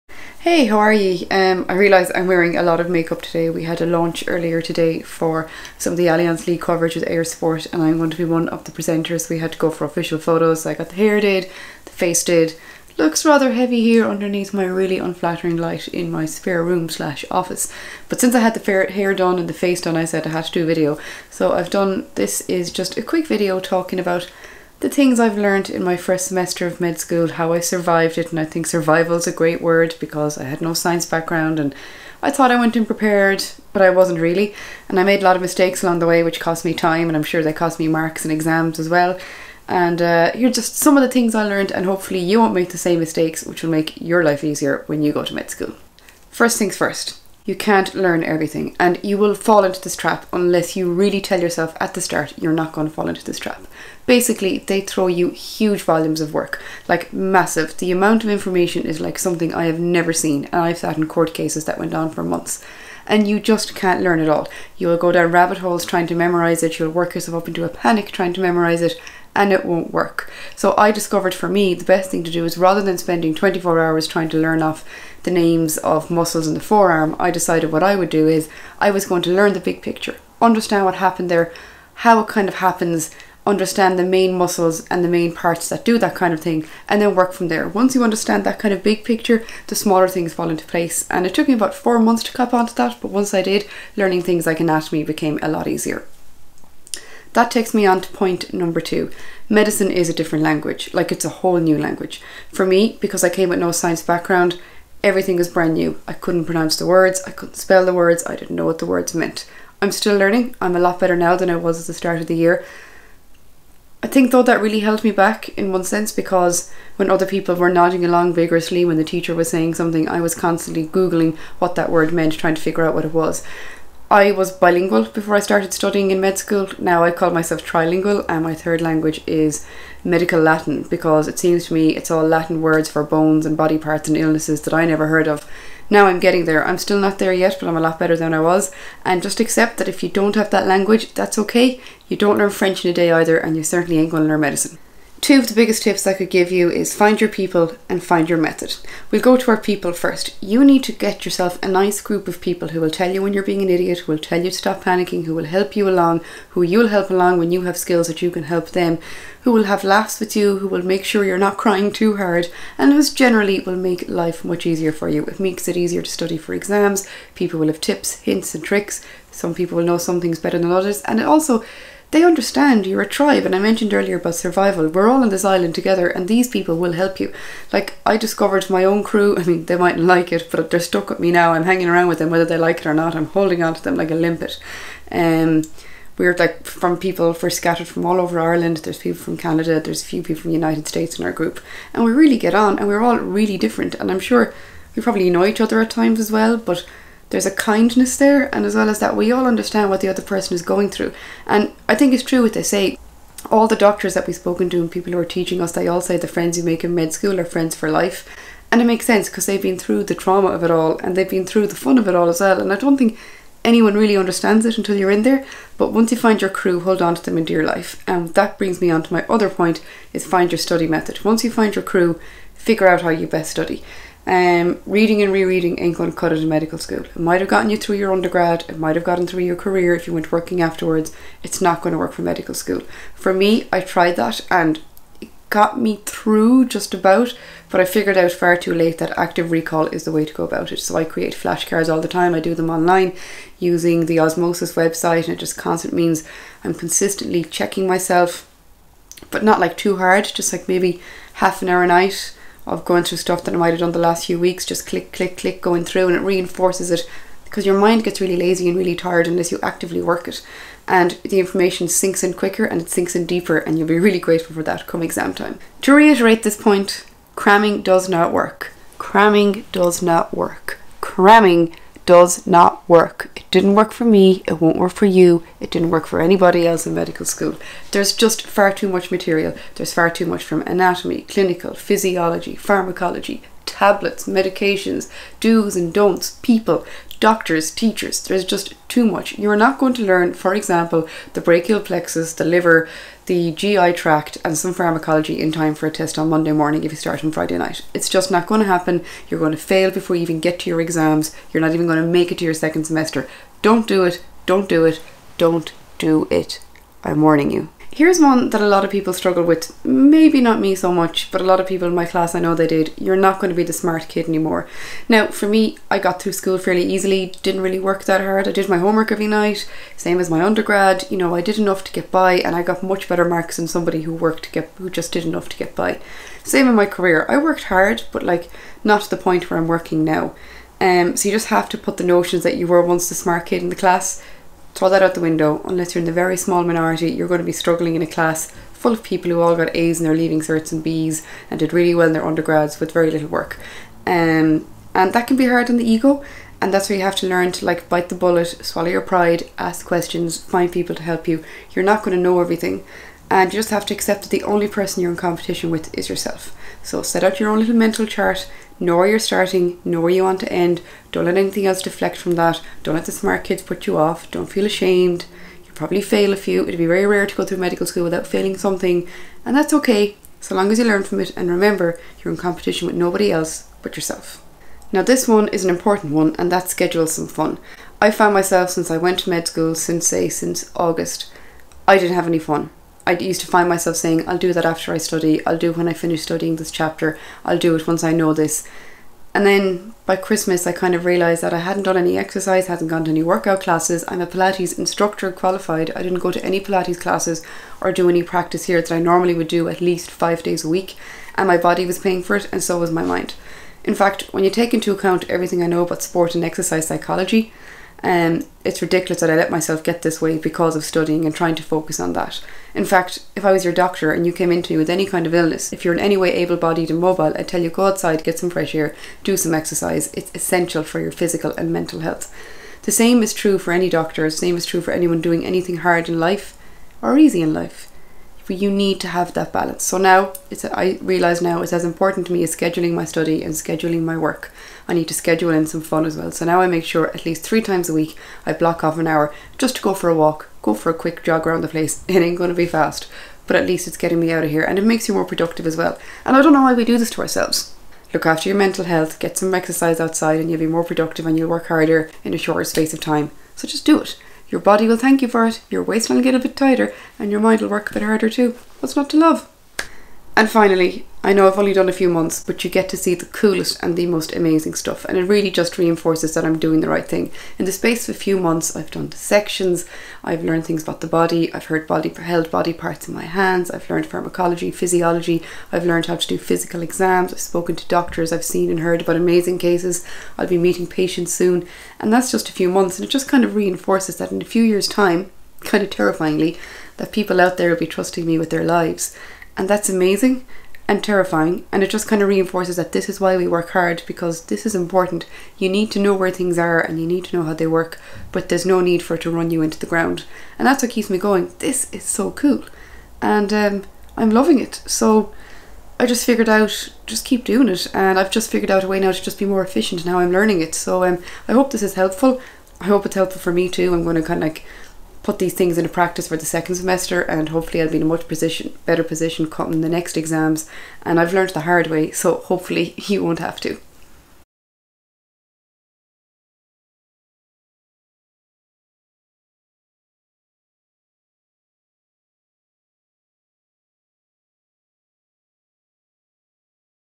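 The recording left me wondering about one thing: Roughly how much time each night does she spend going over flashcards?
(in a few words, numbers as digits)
half an hour.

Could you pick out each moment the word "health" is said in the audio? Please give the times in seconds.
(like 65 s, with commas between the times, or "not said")
421 s, 448 s.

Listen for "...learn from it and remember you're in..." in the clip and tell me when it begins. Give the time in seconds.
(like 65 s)
370 s.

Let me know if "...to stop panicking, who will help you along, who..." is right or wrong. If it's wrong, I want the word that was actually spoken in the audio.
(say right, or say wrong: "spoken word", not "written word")
right.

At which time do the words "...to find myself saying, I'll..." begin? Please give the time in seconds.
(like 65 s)
383 s.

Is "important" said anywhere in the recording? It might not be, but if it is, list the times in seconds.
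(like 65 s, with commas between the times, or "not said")
375 s, 431 s, 494 s.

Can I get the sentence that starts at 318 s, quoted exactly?
I did my homework every night, same as my undergrad.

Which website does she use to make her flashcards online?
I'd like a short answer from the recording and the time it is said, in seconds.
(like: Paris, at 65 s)
Osmosis, at 244 s.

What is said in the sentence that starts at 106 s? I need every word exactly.
I couldn't pronounce the words, I couldn't spell the words, I didn't know what the words meant.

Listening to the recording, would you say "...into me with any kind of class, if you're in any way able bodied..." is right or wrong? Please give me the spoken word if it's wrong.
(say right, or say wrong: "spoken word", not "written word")
wrong: "illness", not "class".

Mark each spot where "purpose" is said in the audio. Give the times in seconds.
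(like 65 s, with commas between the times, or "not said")
not said.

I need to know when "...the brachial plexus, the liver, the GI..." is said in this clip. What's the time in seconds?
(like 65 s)
291 s.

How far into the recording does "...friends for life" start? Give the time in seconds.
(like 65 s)
207 s.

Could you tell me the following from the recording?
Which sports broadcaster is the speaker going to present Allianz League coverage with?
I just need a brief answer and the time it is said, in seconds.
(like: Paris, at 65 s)
Eir Sport, at 7 s.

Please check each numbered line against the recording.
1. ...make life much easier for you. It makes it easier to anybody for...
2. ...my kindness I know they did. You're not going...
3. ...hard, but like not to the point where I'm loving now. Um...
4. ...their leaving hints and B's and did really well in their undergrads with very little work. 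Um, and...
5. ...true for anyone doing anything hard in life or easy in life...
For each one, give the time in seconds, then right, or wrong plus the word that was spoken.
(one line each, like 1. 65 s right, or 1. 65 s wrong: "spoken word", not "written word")
1. 163 s wrong: "study", not "anybody"
2. 311 s wrong: "class", not "kindness"
3. 327 s wrong: "working", not "loving"
4. 340 s wrong: "certs", not "hints"
5. 424 s right.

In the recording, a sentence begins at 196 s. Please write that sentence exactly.
But there's a kindness there, and as well as that, we all understand what the other person is going through.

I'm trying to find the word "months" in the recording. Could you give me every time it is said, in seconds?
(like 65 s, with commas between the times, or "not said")
62 s, 91 s, 462 s, 468 s, 482 s.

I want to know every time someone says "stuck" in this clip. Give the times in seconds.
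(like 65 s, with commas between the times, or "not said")
180 s.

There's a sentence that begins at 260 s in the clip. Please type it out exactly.
And the information sinks in quicker and it sinks in deeper, and you'll be really grateful for that come exam time.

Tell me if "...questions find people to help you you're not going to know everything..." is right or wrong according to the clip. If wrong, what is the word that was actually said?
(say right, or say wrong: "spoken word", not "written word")
right.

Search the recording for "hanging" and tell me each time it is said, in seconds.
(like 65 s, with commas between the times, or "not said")
181 s.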